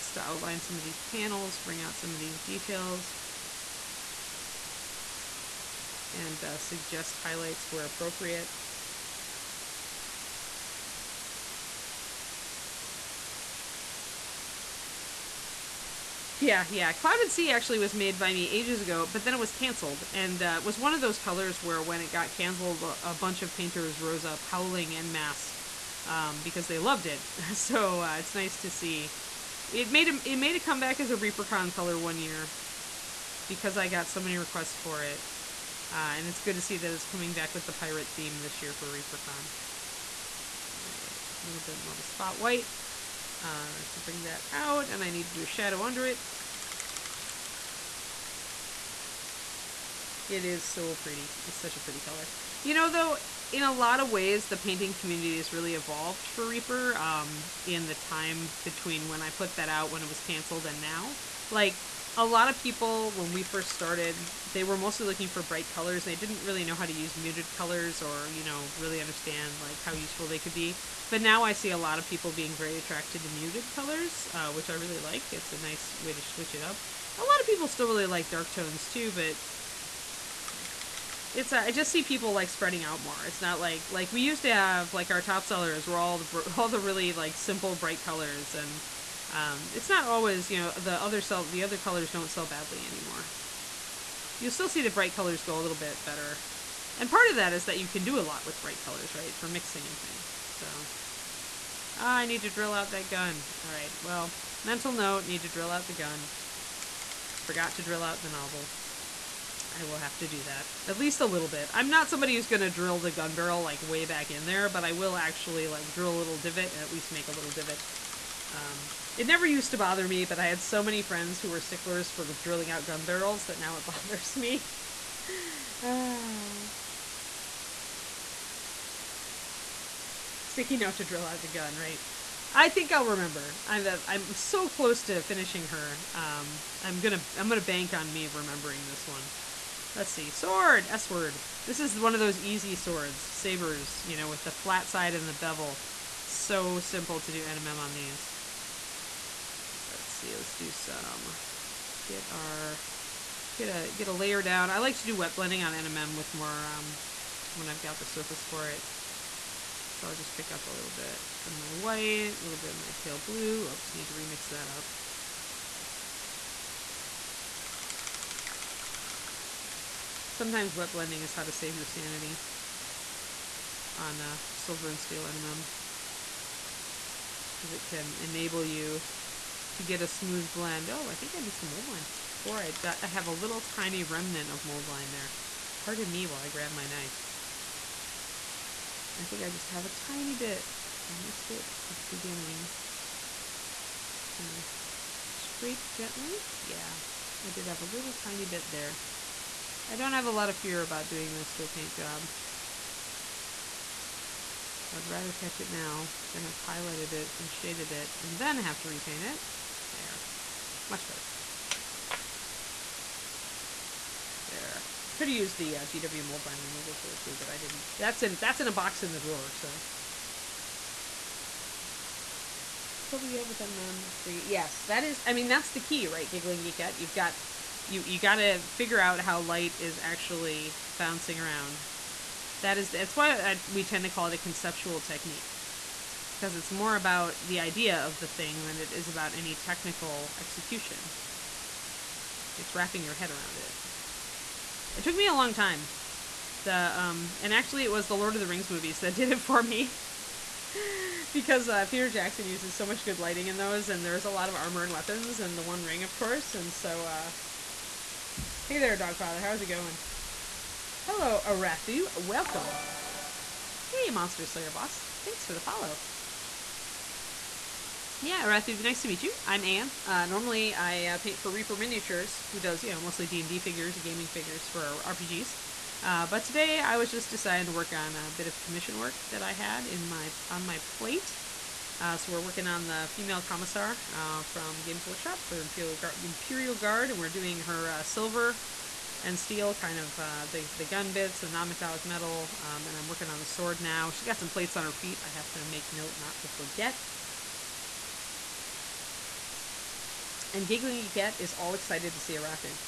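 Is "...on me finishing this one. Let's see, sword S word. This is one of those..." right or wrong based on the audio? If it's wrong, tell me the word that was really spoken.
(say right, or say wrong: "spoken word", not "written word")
wrong: "remembering", not "finishing".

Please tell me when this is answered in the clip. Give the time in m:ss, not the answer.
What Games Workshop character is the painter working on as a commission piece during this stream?
4:43.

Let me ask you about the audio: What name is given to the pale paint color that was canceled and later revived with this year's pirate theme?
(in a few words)
Clouded Sea.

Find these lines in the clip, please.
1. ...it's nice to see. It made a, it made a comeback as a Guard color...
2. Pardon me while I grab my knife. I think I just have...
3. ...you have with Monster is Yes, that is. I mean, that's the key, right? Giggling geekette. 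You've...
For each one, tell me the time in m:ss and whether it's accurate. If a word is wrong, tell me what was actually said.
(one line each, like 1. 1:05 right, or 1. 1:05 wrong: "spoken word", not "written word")
1. 0:28 wrong: "Reapercon", not "Guard"
2. 3:05 right
3. 3:43 wrong: "NMM", not "Monster".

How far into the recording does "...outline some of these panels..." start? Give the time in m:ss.
0:00.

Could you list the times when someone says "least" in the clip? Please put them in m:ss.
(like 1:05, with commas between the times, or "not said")
1:50, 1:56.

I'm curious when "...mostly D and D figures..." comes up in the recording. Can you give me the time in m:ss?
4:33.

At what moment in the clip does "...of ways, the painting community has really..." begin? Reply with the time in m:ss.
0:53.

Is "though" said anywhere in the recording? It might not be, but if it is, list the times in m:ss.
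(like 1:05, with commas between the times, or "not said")
0:52.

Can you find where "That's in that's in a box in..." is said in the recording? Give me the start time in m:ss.
3:37.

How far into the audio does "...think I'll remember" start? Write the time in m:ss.
2:12.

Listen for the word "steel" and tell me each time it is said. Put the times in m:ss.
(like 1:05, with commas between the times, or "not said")
2:54, 4:49.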